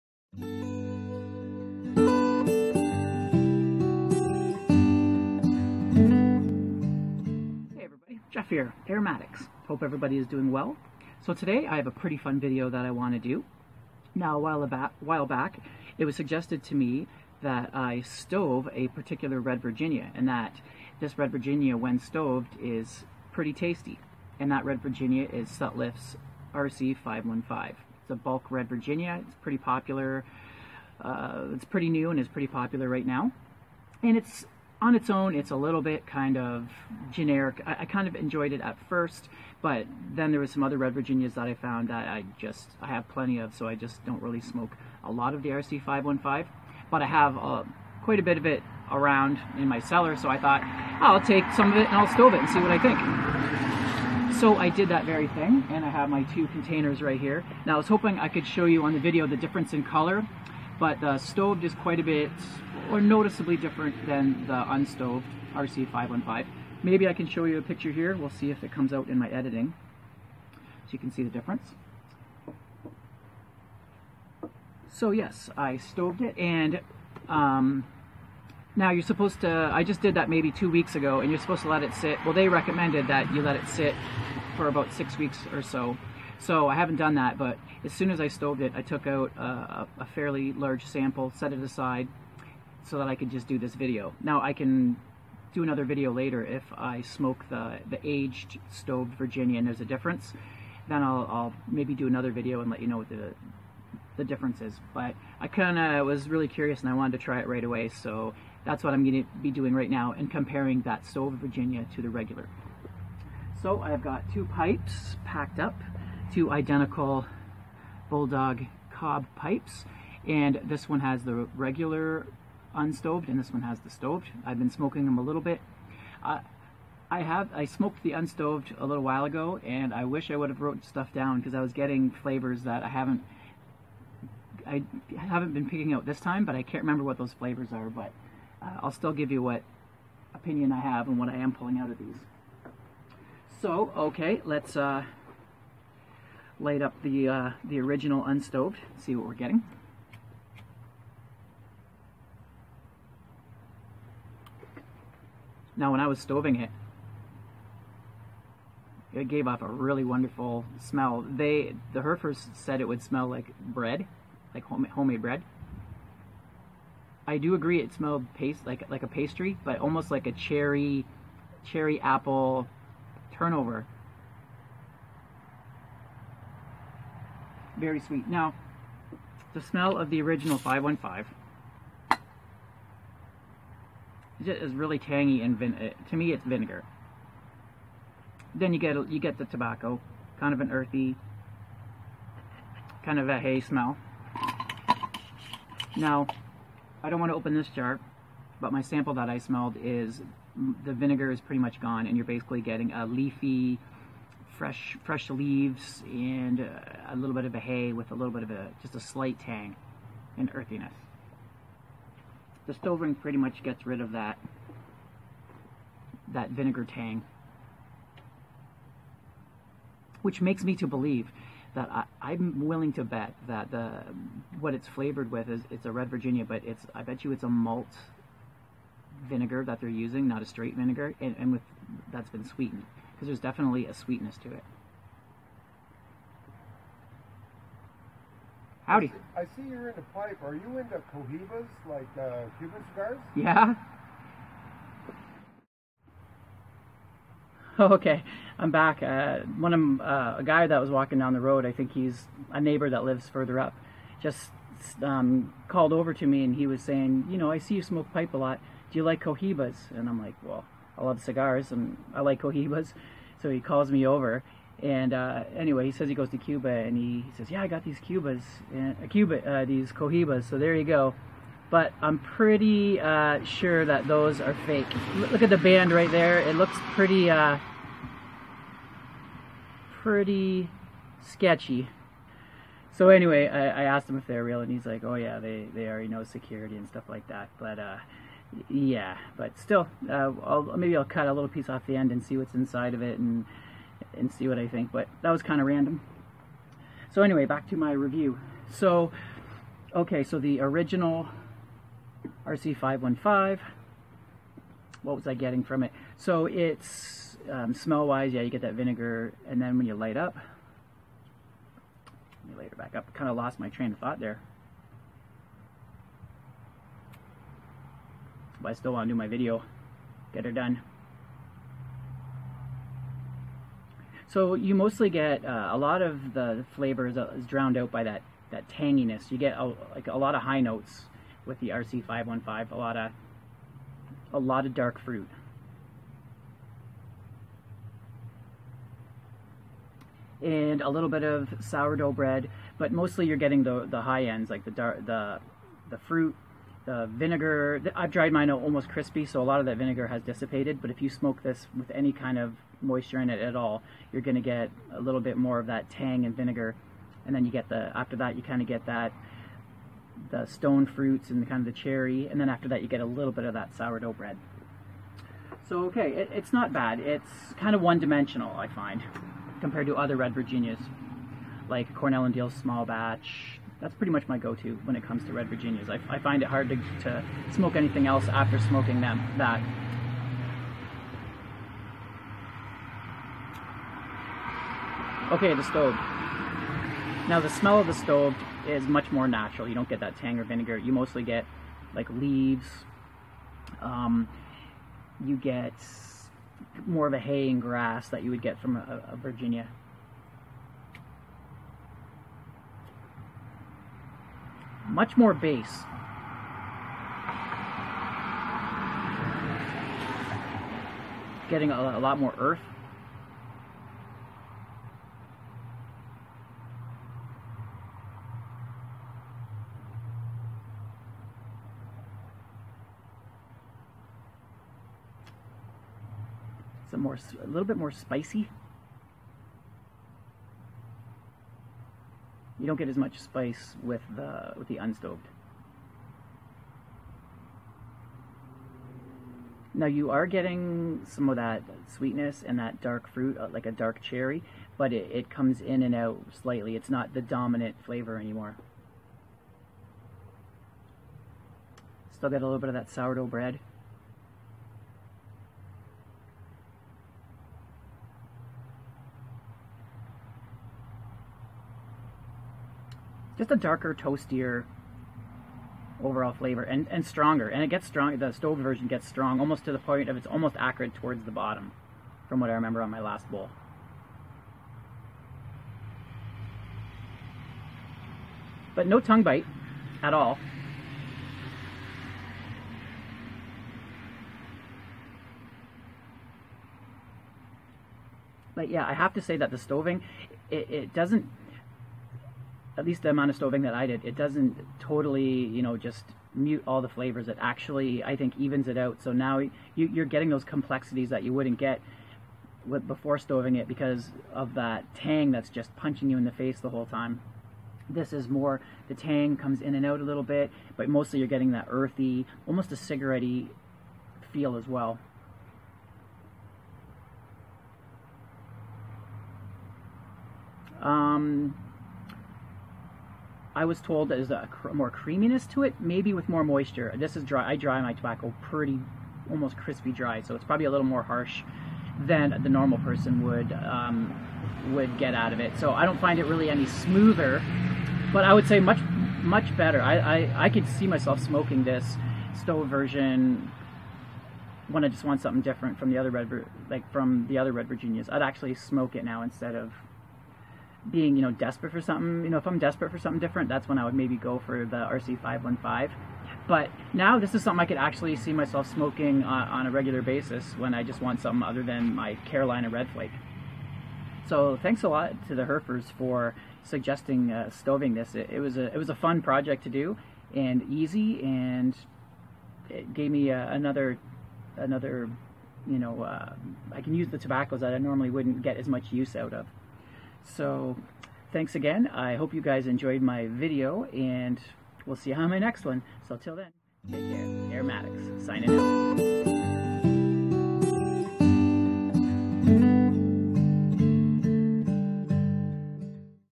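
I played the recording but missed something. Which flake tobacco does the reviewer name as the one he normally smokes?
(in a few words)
Carolina Red Flake.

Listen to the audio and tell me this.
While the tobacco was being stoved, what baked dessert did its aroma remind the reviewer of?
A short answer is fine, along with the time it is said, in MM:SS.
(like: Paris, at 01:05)
cherry apple turnover, at 02:51.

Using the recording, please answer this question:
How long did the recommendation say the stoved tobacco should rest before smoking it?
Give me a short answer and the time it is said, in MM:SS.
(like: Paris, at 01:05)
about 6 weeks, at 01:24.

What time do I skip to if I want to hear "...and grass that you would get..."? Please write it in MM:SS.
06:37.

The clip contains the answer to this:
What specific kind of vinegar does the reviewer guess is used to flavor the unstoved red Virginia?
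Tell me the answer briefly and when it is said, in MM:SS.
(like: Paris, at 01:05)
malt vinegar, at 03:47.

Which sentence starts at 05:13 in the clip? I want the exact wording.
Kind of lost my train of thought there.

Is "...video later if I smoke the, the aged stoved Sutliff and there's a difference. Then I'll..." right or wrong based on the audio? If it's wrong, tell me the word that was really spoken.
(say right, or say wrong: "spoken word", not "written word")
wrong: "Virginia", not "Sutliff".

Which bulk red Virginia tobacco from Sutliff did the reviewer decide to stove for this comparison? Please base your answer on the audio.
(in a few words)
RC515.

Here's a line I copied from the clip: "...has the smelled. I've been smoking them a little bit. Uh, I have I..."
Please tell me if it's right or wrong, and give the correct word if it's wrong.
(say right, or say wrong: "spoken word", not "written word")
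wrong: "stoved", not "smelled".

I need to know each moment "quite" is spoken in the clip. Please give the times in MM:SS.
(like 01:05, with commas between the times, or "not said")
00:48, 01:01.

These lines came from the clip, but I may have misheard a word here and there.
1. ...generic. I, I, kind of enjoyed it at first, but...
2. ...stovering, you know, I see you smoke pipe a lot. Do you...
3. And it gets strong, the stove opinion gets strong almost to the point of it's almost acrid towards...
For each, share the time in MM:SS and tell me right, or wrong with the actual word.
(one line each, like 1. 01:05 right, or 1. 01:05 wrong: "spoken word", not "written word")
1. 00:37 right
2. 04:16 wrong: "saying", not "stovering"
3. 07:47 wrong: "version", not "opinion".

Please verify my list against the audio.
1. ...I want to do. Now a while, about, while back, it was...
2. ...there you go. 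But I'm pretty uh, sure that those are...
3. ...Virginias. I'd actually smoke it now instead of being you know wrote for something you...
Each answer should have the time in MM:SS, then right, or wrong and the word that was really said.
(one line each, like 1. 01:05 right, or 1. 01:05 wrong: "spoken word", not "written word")
1. 00:12 right
2. 04:30 right
3. 09:07 wrong: "desperate", not "wrote".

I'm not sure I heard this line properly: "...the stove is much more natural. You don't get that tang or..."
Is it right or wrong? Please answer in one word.
right.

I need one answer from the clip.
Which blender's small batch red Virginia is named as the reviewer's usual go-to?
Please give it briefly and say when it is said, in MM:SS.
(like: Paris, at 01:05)
Cornell and Diehl, at 06:11.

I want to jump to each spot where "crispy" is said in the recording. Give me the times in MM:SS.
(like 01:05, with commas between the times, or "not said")
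05:48, 08:49.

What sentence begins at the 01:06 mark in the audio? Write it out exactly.
Maybe I can show you a picture here.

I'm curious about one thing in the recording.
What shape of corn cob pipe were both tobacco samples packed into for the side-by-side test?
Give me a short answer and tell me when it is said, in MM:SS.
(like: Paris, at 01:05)
Bulldog, at 01:58.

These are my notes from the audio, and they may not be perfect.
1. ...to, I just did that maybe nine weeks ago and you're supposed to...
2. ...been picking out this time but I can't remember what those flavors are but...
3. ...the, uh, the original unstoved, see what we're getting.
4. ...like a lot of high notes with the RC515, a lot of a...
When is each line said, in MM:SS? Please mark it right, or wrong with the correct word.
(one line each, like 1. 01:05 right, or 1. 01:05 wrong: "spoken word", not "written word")
1. 01:19 wrong: "two", not "nine"
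2. 02:15 right
3. 02:27 right
4. 05:29 right.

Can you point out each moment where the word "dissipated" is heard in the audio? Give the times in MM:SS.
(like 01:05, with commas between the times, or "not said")
05:50.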